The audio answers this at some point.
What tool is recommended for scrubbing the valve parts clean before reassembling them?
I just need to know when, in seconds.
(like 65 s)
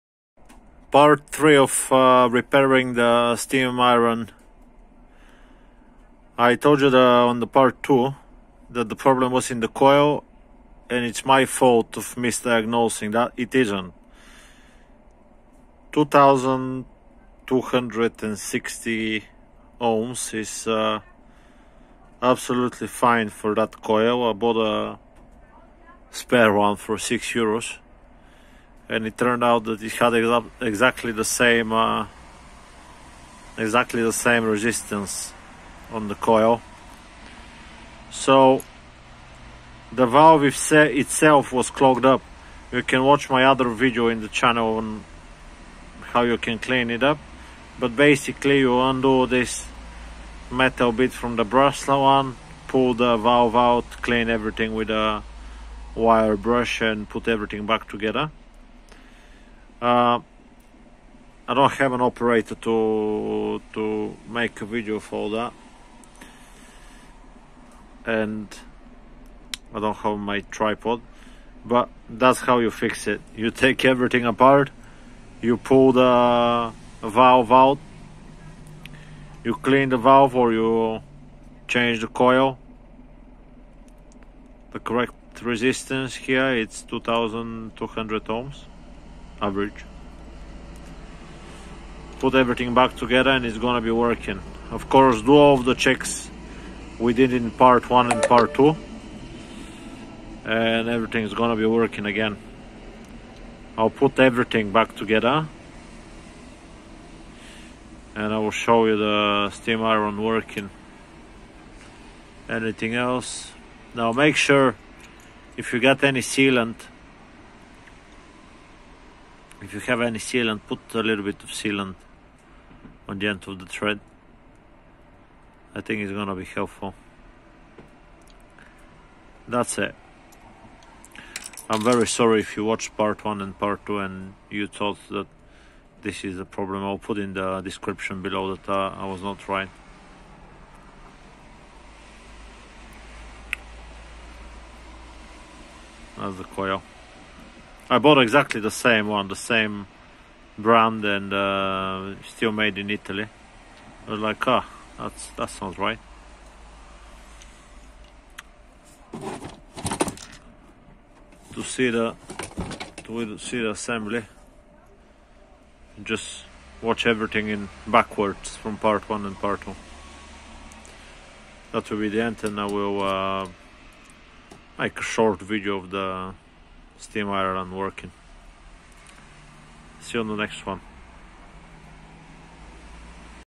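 55 s.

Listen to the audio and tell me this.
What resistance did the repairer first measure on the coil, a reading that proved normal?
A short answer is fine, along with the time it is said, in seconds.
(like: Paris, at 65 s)
2260 ohms, at 15 s.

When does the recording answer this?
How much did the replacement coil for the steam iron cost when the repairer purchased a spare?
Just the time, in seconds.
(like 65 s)
26 s.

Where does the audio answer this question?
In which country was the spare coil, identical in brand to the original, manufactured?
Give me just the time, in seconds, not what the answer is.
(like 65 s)
152 s.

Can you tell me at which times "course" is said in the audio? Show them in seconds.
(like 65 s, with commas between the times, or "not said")
94 s.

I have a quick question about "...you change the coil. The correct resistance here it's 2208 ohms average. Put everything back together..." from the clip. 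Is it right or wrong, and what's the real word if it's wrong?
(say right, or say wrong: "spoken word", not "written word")
wrong: "2200", not "2208".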